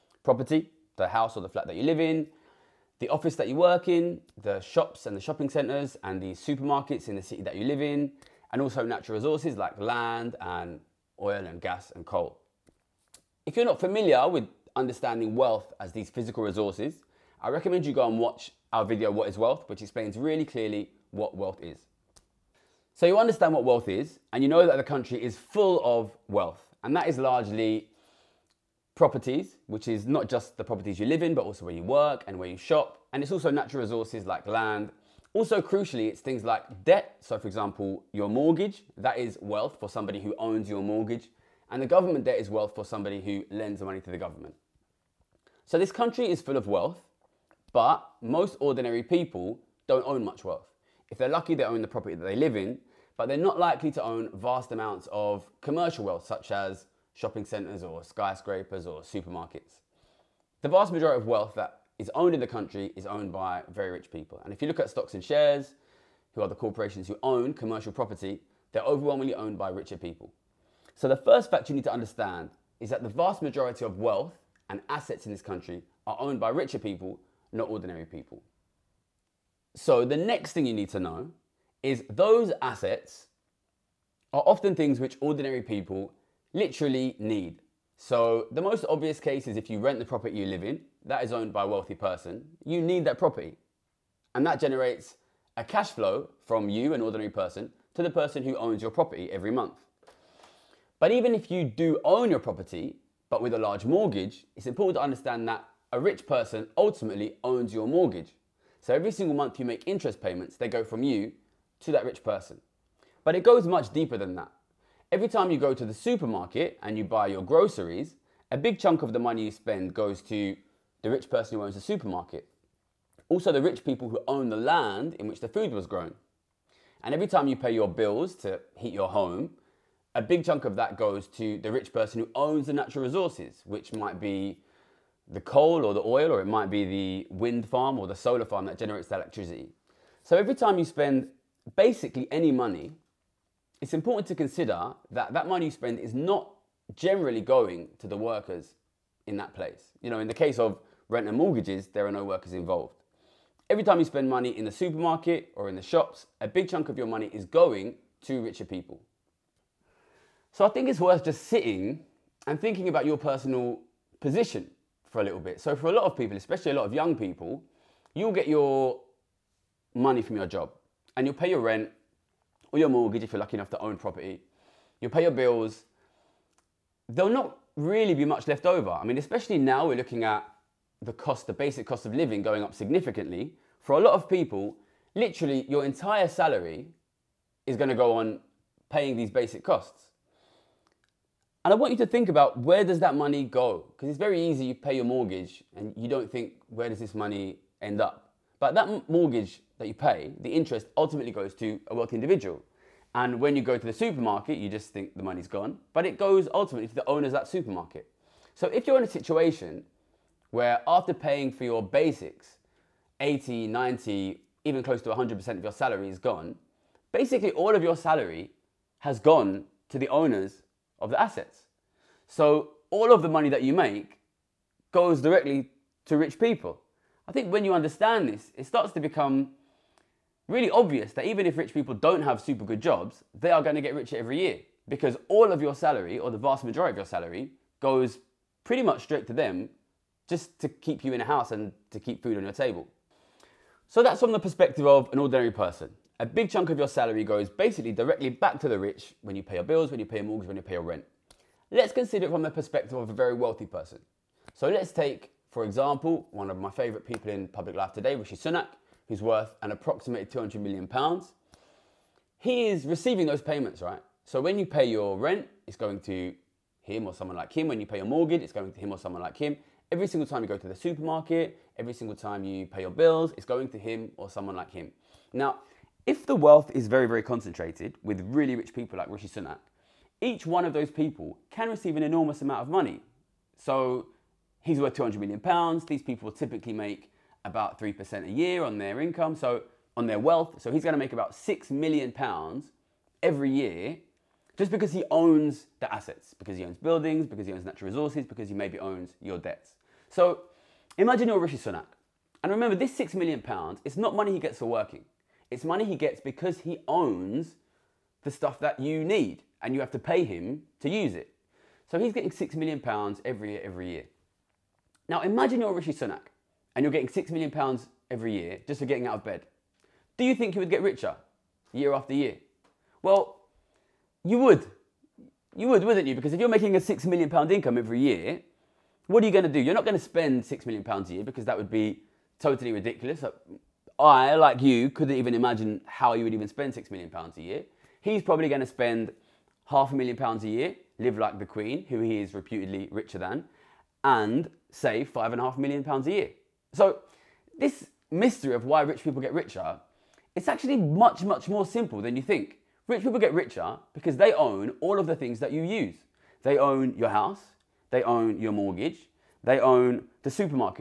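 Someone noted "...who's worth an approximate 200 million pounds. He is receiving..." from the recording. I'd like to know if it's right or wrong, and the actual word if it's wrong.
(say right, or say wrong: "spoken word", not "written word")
right.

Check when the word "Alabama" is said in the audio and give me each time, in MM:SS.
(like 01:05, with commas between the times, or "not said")
not said.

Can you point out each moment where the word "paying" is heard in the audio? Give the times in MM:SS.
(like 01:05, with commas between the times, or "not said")
03:08, 03:31.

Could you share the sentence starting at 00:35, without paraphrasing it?
Also, crucially, it's things like debt.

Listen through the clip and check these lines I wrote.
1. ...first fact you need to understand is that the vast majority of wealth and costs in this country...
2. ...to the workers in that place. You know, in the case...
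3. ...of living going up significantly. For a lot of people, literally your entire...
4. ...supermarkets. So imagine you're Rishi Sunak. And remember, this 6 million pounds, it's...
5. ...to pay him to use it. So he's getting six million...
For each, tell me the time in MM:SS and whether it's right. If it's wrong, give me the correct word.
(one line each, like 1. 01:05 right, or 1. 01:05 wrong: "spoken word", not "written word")
1. 01:11 wrong: "assets", not "costs"
2. 02:27 right
3. 03:02 right
4. 04:59 wrong: "debts", not "supermarkets"
5. 05:09 right.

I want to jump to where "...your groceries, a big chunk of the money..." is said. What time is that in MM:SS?
01:57.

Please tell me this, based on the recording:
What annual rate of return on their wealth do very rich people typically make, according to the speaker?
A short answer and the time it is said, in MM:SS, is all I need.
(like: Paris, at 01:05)
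3%, at 04:47.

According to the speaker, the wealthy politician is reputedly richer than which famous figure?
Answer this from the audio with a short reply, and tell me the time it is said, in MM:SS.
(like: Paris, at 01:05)
the Queen, at 05:41.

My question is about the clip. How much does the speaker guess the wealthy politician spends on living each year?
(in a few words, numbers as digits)
half a million pounds.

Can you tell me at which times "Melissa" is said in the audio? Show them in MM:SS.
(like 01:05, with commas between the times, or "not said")
not said.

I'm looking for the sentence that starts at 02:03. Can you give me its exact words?
Also, the rich people who own the land in which the food was grown.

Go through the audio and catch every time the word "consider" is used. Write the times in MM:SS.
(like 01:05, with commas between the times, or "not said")
02:24, 04:11.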